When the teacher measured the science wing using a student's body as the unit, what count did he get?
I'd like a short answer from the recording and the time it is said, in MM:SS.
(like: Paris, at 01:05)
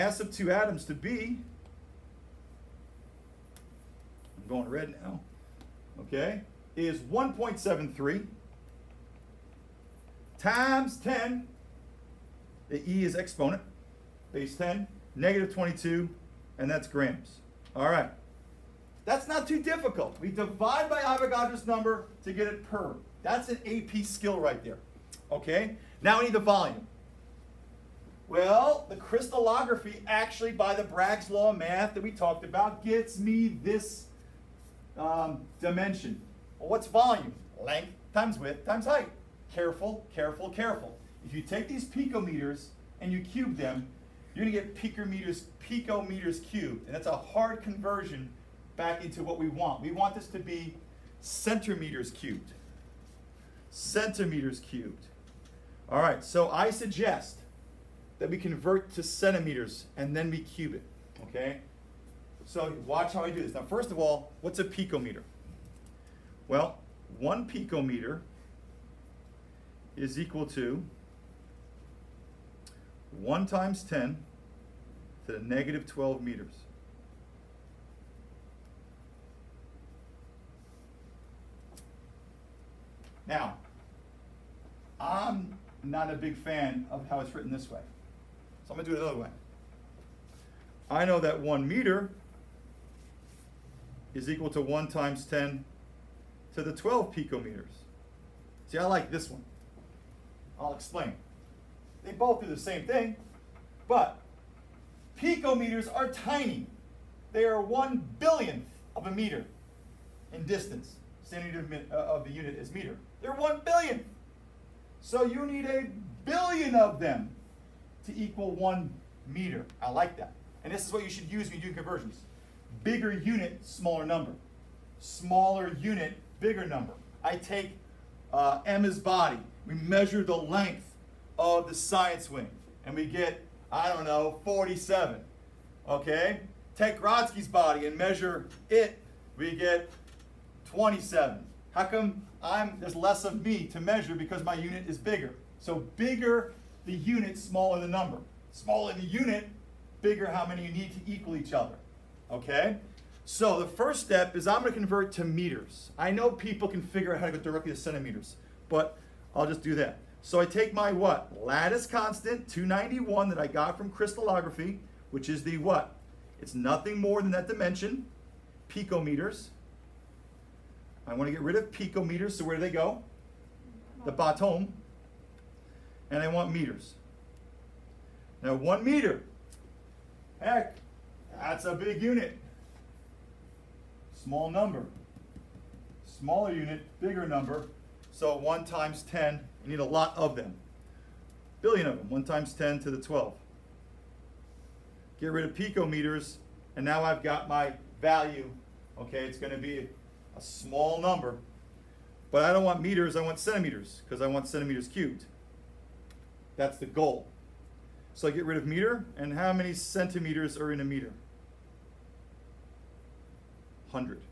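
47, at 02:14.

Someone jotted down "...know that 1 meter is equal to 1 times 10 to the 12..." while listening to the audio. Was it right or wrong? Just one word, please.
right.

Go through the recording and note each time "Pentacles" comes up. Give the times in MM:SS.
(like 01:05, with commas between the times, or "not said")
not said.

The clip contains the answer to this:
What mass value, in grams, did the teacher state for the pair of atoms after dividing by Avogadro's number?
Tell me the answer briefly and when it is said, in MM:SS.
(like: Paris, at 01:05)
1.73 x 10^-22 grams, at 00:07.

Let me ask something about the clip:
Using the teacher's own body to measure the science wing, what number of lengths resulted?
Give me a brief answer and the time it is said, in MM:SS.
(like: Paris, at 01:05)
27, at 02:20.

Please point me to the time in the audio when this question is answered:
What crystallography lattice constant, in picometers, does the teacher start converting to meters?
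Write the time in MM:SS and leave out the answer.
02:42.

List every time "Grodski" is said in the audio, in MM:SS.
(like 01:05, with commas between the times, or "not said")
02:17.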